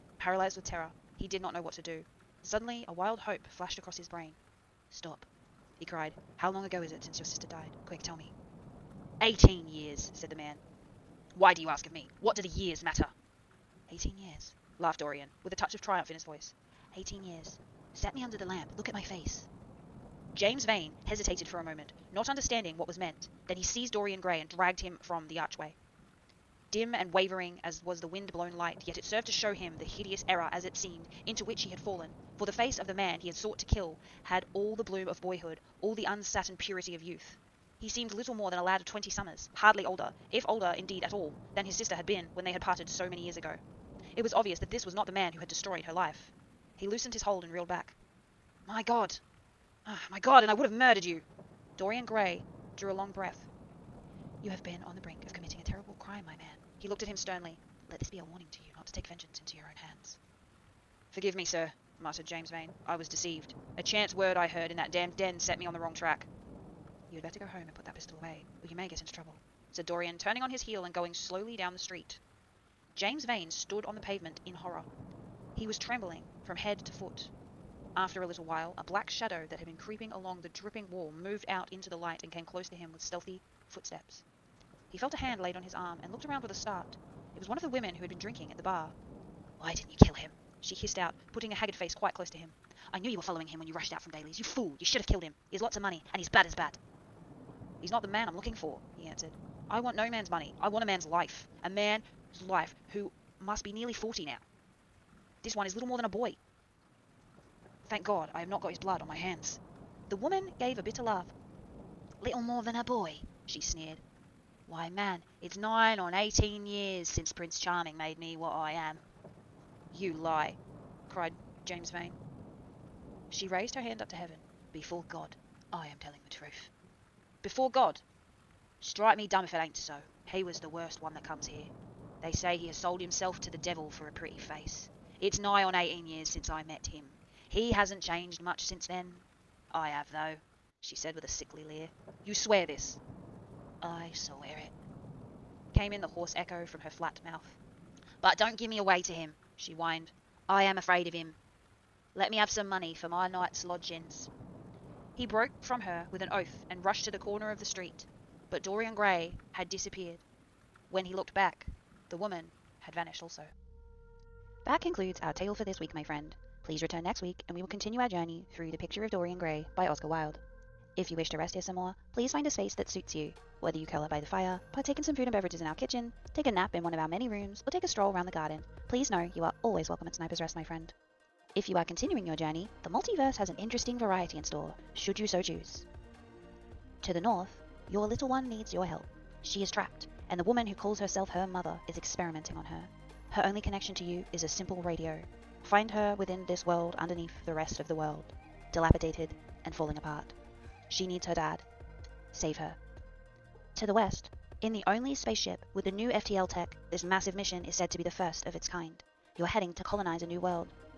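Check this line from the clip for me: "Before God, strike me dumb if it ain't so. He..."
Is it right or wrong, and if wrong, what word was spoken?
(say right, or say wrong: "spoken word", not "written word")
right.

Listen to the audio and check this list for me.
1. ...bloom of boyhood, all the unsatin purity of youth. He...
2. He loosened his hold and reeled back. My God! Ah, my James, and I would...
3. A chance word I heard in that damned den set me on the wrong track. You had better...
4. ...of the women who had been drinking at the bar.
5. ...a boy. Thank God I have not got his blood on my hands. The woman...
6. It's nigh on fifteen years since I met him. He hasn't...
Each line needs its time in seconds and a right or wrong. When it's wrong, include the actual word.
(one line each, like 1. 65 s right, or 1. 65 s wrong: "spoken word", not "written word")
1. 34 s right
2. 46 s wrong: "God", not "James"
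3. 63 s right
4. 87 s right
5. 106 s right
6. 135 s wrong: "eighteen", not "fifteen".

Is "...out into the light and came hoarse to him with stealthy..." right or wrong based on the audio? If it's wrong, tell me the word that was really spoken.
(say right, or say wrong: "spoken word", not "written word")
wrong: "close", not "hoarse".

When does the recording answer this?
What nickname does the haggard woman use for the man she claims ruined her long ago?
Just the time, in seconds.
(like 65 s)
117 s.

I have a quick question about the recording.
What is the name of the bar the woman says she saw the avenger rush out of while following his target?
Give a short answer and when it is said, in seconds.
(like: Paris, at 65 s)
Daly's, at 94 s.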